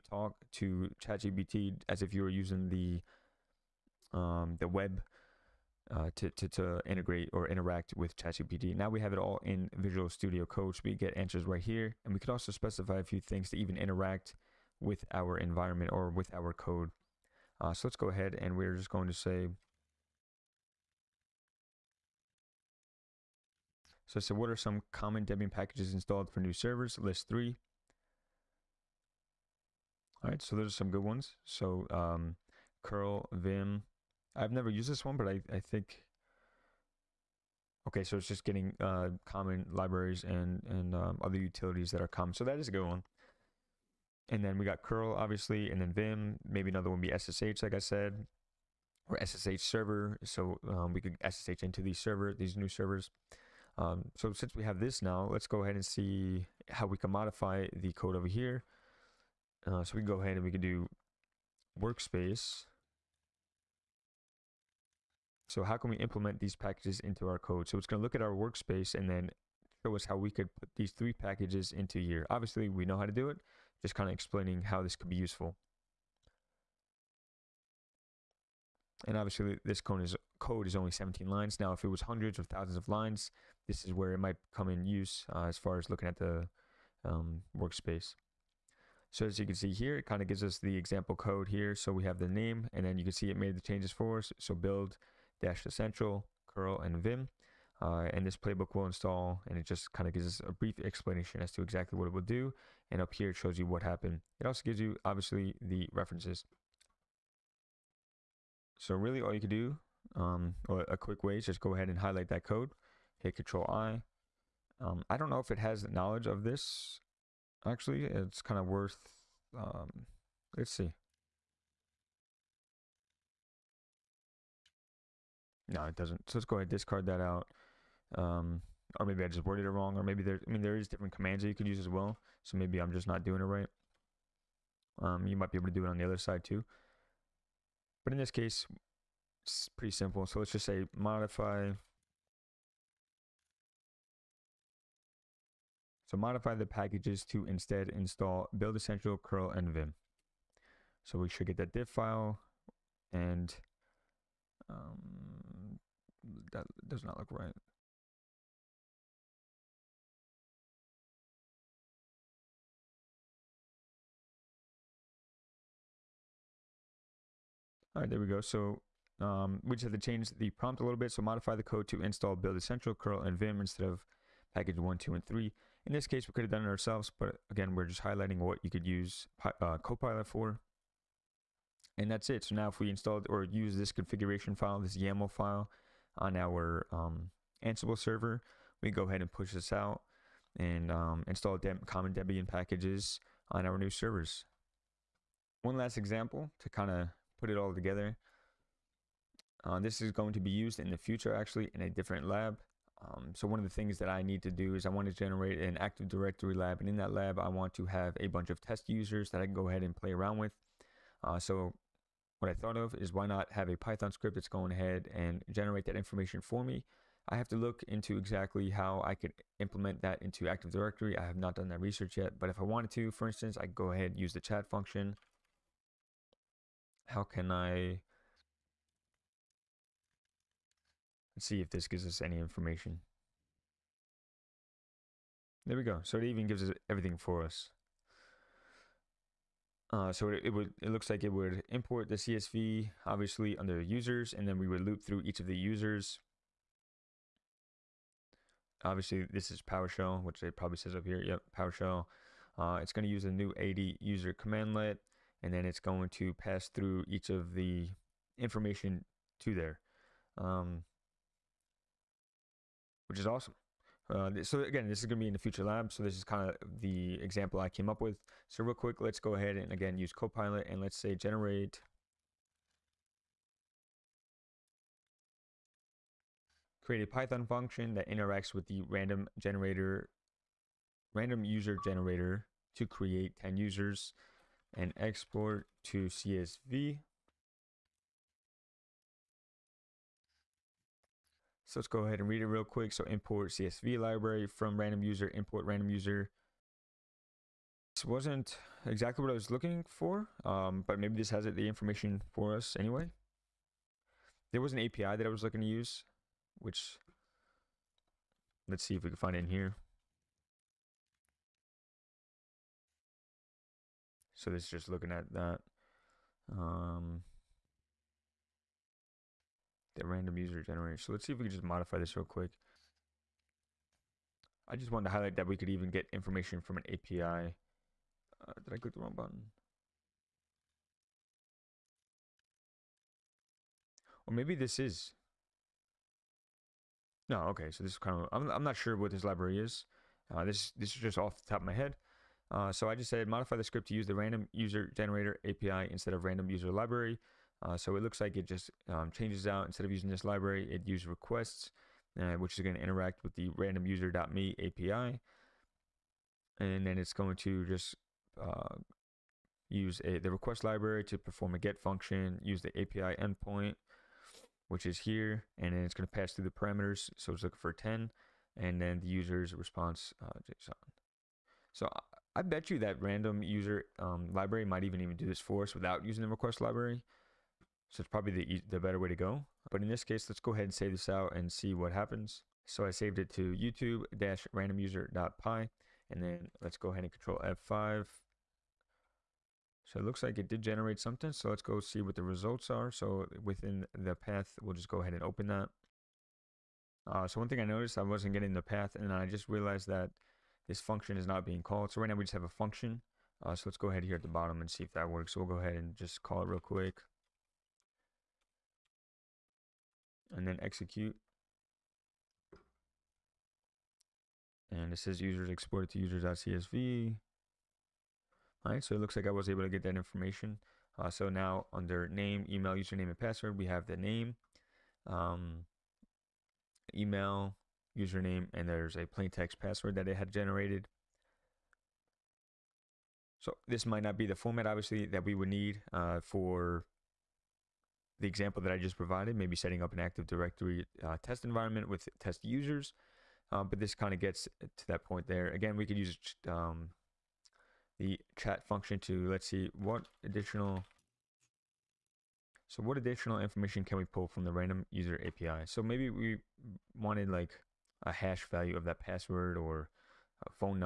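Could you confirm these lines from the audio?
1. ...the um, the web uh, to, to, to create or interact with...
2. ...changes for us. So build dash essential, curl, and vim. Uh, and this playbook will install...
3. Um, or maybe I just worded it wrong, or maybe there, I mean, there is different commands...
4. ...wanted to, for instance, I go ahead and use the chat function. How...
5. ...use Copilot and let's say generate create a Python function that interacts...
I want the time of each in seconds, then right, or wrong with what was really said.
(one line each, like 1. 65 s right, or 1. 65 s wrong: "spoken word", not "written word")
1. 2 s wrong: "integrate", not "create"
2. 93 s right
3. 128 s right
4. 222 s right
5. 269 s right.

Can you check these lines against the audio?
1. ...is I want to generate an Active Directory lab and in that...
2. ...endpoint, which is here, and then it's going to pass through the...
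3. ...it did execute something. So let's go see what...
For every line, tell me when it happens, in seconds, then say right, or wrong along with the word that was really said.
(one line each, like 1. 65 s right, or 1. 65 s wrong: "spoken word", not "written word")
1. 204 s right
2. 363 s right
3. 390 s wrong: "generate", not "execute".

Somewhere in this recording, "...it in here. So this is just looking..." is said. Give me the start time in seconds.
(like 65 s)
309 s.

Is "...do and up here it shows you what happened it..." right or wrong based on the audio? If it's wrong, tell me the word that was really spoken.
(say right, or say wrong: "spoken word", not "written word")
right.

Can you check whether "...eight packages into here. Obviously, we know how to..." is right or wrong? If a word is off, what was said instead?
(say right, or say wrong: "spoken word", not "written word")
wrong: "three", not "eight".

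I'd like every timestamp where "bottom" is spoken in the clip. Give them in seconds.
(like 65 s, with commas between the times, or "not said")
404 s.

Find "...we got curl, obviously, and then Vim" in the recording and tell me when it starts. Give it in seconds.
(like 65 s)
44 s.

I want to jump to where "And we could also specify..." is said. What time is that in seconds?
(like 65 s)
12 s.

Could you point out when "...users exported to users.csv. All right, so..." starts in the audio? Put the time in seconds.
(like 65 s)
415 s.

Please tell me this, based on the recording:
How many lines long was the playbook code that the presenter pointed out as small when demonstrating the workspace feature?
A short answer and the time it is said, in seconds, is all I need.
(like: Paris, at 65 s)
17, at 80 s.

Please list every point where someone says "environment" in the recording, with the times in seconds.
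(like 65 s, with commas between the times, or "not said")
15 s, 441 s.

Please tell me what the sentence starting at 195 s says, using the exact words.
One last example to kind of put it all together.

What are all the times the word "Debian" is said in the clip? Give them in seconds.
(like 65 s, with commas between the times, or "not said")
25 s, 192 s.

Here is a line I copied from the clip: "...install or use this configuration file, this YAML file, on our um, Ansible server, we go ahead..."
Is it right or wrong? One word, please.
right.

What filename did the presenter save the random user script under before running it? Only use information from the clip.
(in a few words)
youtube-randomuser.py.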